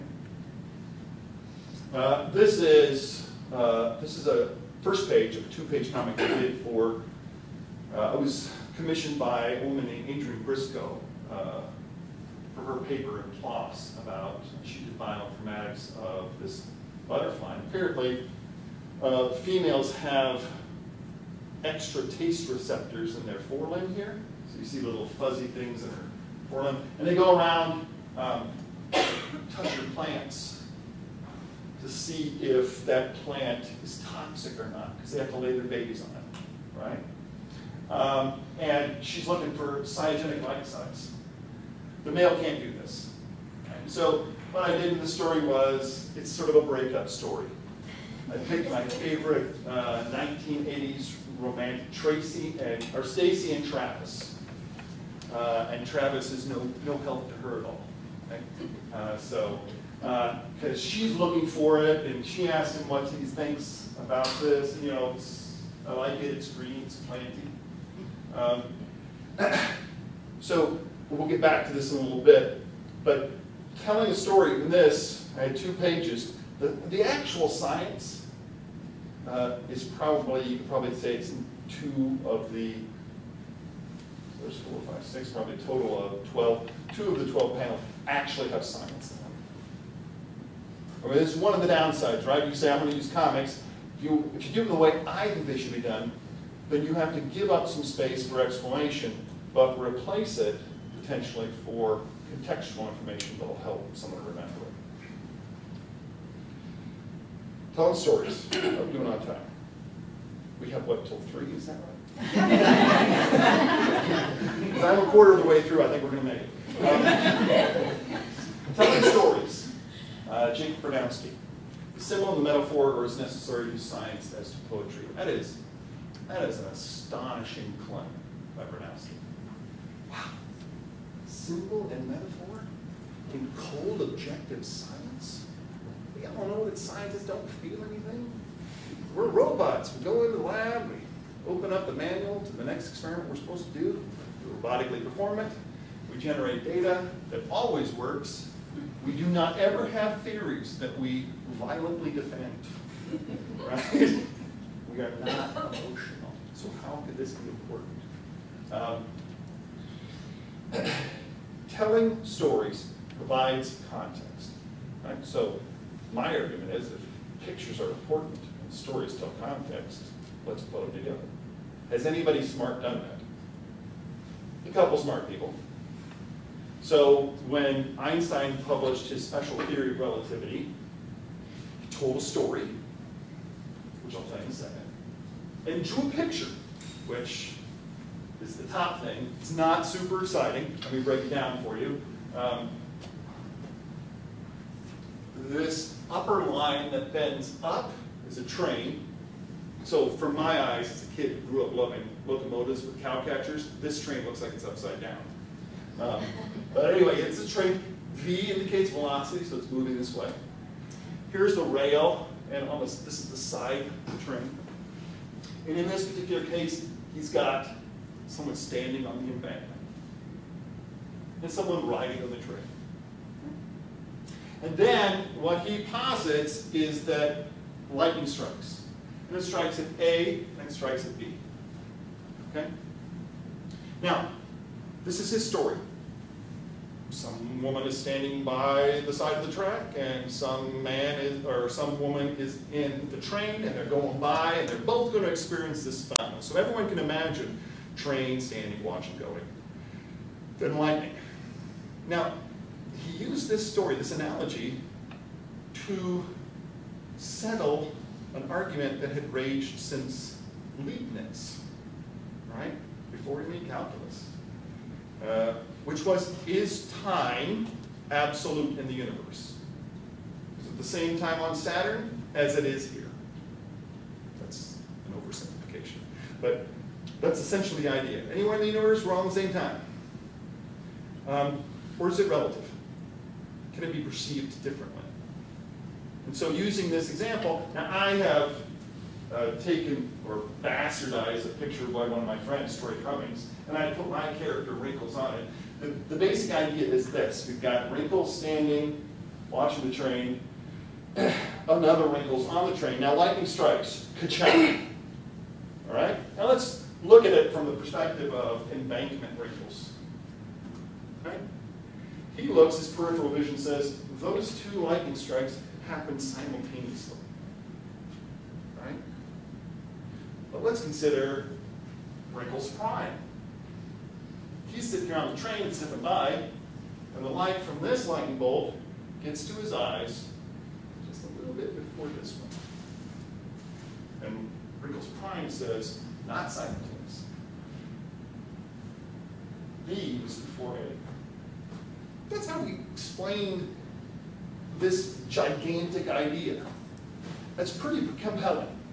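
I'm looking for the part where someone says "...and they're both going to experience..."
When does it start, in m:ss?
4:04.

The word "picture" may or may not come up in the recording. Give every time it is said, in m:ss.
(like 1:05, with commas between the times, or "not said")
2:47, 3:06, 4:51.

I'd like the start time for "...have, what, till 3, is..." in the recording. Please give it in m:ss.
1:50.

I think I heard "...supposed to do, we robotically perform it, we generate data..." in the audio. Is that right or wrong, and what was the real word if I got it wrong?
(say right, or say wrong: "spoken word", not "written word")
right.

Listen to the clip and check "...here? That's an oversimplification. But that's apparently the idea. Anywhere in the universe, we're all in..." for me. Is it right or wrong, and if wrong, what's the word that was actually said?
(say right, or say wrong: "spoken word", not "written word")
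wrong: "essentially", not "apparently".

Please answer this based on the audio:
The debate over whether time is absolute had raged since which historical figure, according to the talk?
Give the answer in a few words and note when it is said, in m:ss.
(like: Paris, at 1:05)
Leibniz, at 4:20.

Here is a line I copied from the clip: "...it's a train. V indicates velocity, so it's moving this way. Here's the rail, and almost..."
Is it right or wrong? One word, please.
right.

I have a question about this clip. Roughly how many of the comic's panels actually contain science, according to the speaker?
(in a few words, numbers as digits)
2.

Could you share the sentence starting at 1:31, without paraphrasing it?
I mean, this is one of the downsides, right?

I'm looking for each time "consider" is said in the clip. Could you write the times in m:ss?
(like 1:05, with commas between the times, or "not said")
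5:20.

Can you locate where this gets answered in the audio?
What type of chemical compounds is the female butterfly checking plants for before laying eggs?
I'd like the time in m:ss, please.
0:39.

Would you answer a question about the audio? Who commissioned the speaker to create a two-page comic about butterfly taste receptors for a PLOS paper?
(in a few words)
Adriana Briscoe.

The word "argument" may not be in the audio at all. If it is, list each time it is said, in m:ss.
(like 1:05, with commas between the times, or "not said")
2:46, 4:18.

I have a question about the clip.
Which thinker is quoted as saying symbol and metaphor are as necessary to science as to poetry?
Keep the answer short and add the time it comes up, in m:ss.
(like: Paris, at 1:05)
Jake Bronowski, at 2:00.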